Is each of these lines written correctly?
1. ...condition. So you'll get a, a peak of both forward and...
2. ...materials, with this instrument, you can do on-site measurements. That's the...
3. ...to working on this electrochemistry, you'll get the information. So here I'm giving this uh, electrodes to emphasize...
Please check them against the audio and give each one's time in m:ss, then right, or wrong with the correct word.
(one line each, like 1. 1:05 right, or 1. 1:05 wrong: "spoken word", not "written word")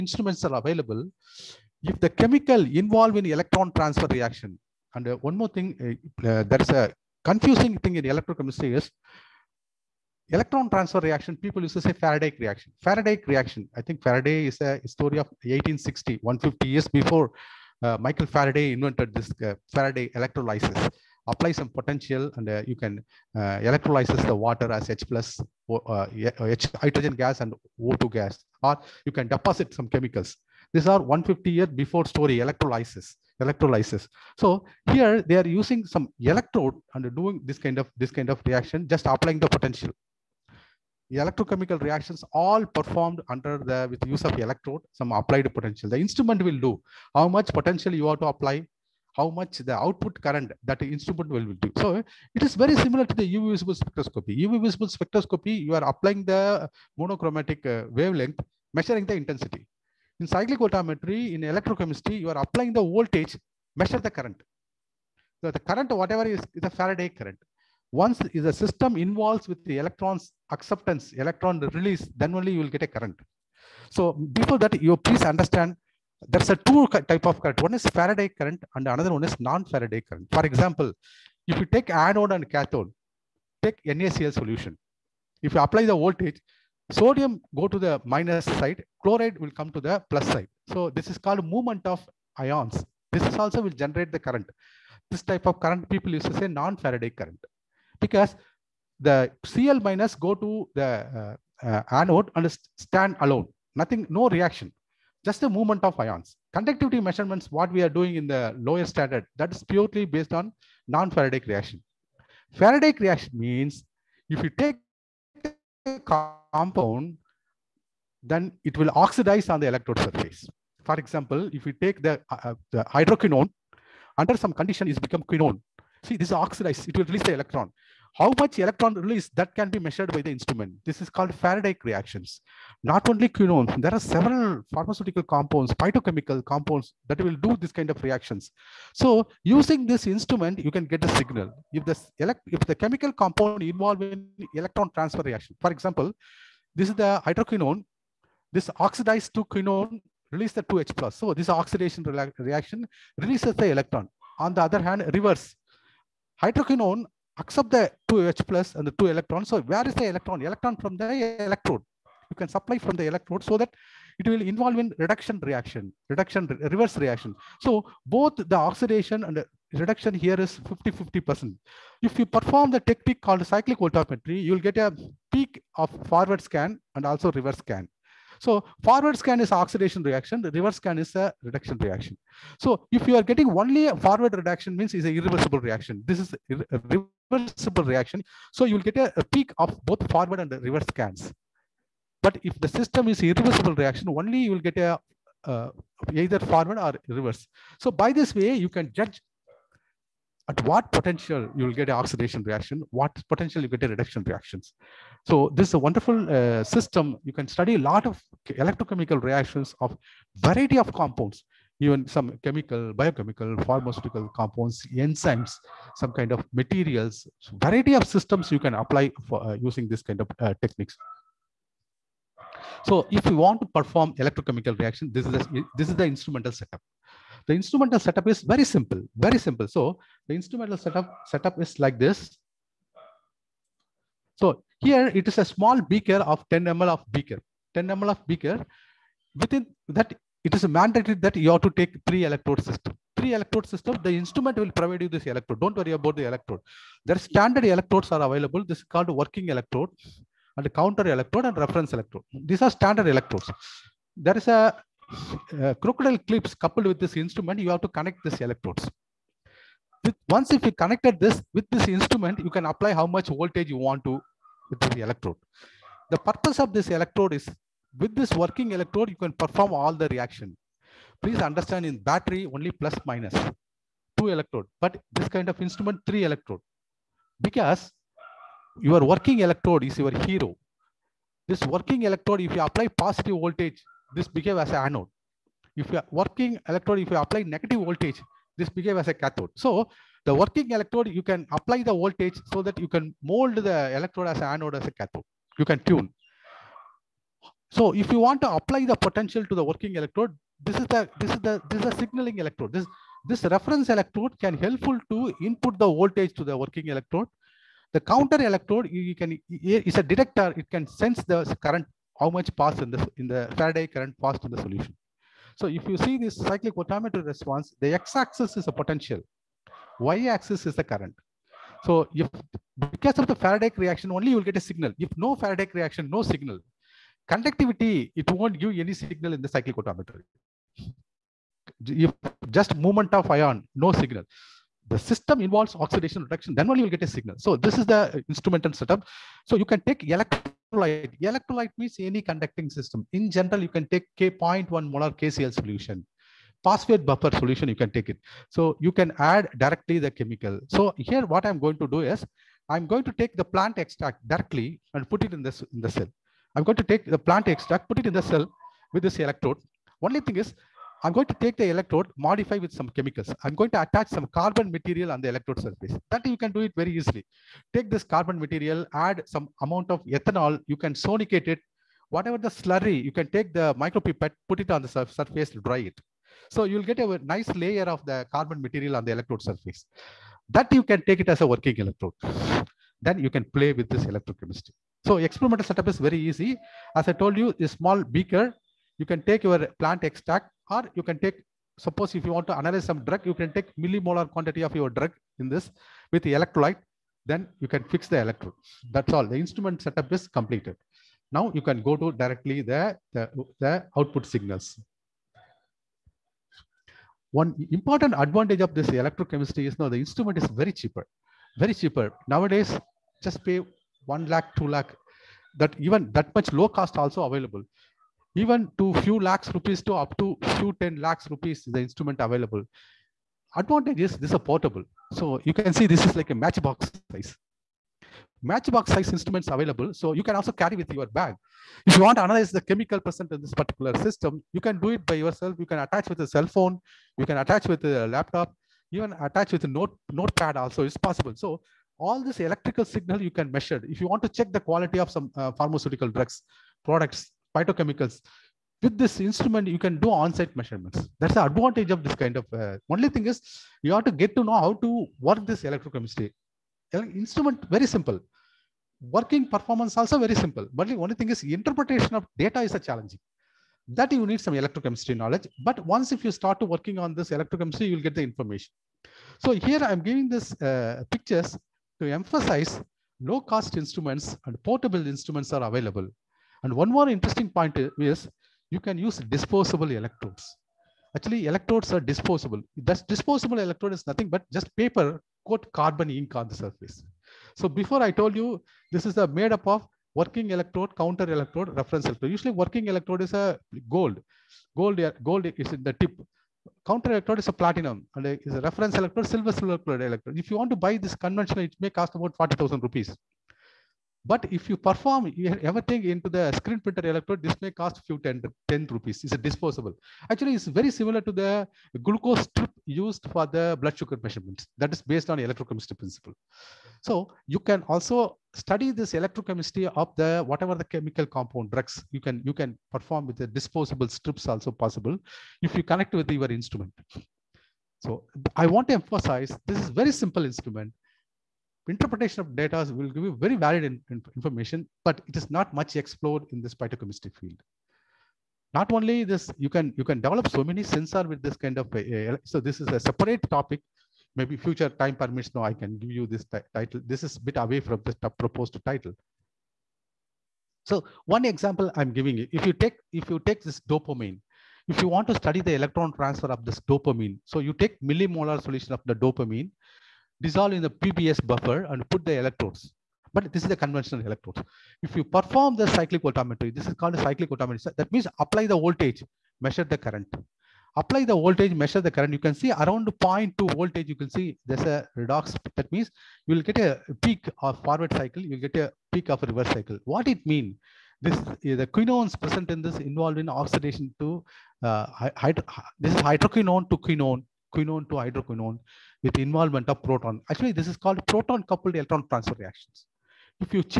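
1. 3:07 wrong: "reaction", not "condition"
2. 7:27 wrong: "phytochemicals", not "materials"
3. 7:46 wrong: "pictures", not "electrodes".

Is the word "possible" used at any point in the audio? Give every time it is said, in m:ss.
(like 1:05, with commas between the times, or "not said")
7:20, 8:44.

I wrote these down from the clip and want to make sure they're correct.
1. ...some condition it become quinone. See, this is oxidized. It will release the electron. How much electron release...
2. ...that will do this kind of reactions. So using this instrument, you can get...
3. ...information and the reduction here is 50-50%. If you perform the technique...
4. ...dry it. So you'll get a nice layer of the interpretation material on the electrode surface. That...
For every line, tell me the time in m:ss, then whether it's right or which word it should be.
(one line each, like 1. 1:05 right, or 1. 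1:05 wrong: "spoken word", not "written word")
1. 2:04 right
2. 2:17 right
3. 2:48 wrong: "oxidation", not "information"
4. 6:15 wrong: "carbon", not "interpretation".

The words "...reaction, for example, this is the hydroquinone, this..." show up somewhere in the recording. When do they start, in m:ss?
2:25.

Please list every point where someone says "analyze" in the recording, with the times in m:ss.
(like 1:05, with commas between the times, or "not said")
6:32, 7:12.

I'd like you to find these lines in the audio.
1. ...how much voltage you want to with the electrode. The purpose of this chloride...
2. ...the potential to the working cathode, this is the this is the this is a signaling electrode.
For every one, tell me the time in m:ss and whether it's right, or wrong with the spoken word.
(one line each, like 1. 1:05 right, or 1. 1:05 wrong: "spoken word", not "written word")
1. 4:22 wrong: "electrode", not "chloride"
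2. 4:58 wrong: "electrode", not "cathode".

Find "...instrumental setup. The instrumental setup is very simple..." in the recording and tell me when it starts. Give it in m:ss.
3:46.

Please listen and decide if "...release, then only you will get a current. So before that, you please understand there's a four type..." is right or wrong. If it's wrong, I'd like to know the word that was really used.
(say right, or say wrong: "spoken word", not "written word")
wrong: "two", not "four".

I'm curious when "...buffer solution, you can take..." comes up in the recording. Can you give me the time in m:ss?
5:47.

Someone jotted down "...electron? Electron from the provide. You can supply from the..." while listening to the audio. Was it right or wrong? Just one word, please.
wrong.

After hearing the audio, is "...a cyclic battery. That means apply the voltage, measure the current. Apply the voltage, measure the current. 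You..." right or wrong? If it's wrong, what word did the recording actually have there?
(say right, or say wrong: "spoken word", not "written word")
wrong: "voltammetry", not "battery".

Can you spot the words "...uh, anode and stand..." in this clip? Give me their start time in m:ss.
1:41.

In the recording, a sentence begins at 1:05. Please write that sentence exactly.
So the current, whatever is, is a Faraday current.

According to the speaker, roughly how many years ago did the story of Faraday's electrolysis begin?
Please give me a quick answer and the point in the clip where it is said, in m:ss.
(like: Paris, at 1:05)
150 years, at 0:16.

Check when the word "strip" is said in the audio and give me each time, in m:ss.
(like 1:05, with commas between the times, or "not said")
8:32, 8:44.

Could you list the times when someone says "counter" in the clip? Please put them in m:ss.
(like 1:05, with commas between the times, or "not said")
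4:10, 5:08, 8:11, 8:16.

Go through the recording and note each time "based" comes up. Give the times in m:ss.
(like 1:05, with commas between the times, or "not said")
1:50, 8:35.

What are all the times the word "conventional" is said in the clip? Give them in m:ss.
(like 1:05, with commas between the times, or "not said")
8:21, 9:23.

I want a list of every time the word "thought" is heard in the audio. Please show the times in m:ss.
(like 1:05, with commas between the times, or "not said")
not said.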